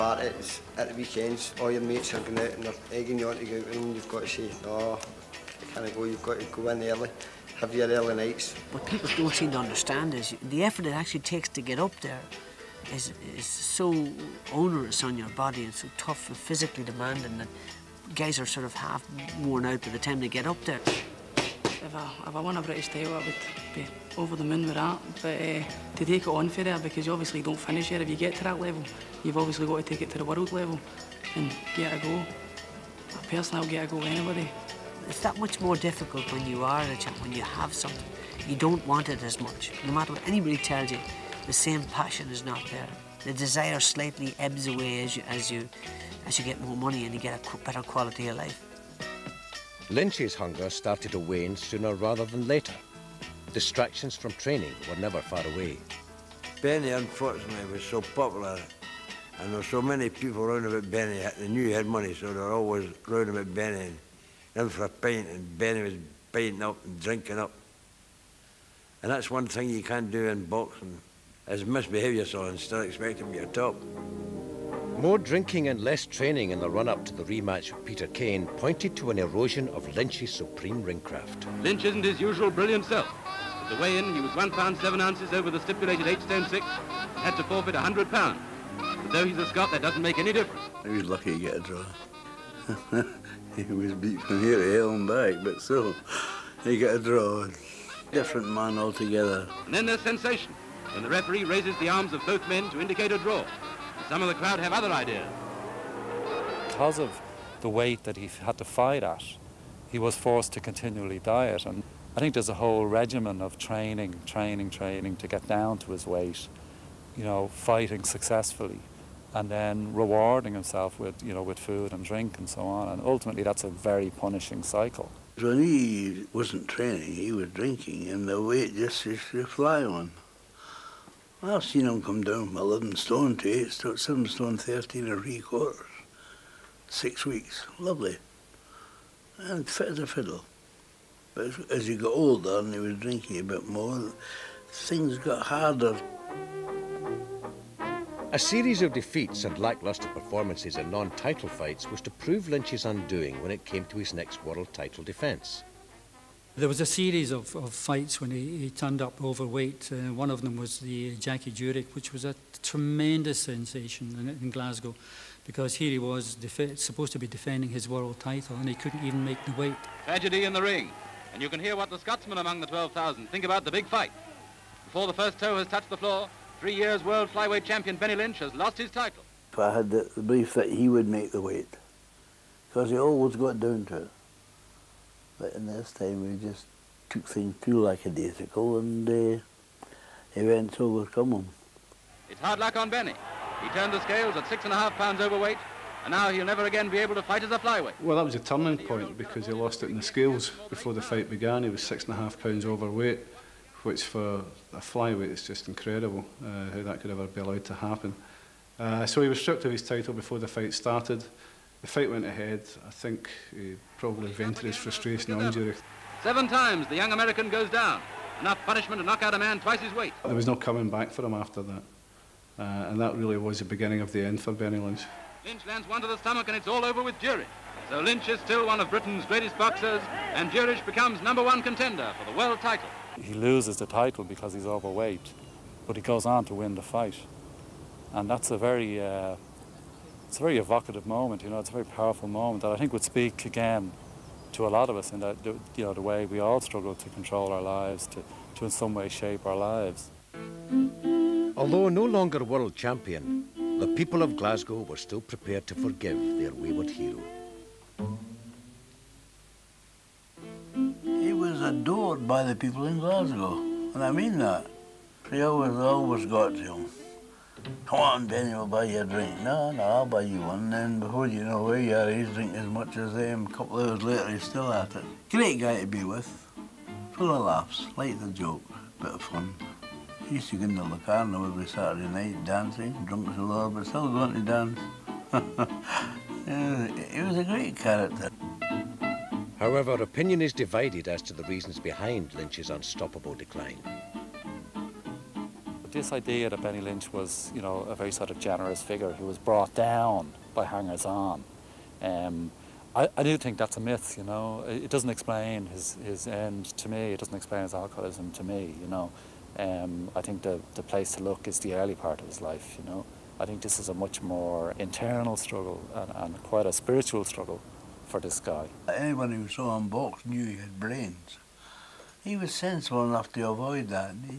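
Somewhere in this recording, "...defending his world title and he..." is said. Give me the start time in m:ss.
2:47.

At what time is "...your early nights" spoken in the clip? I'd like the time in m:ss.
0:07.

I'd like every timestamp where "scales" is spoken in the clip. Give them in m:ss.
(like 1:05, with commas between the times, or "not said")
3:14, 3:20.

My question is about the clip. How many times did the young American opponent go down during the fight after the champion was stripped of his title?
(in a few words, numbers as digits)
7.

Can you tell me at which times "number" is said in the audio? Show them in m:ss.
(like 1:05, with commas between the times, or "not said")
3:51.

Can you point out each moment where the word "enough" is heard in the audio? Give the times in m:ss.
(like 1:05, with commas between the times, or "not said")
3:38, 5:23.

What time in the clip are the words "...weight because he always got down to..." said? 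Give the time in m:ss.
3:01.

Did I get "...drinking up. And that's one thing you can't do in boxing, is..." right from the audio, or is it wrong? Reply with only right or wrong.
right.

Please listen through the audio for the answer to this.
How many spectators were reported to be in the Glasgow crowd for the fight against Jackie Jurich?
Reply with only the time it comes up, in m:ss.
2:52.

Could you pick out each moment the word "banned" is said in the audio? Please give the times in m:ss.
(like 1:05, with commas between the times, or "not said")
not said.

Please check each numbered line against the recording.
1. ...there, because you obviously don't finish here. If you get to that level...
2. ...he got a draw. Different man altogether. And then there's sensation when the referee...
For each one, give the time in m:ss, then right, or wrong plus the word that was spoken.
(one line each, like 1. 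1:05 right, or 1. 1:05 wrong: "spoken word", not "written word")
1. 0:26 right
2. 1:36 right.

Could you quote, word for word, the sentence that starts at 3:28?
Uh, so he was stripped of his title before the fight started.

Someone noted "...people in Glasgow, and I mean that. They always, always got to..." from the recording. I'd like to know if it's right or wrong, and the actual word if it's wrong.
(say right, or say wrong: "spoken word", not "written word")
right.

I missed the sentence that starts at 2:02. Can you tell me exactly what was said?
And ultimately, that's a very punishing cycle.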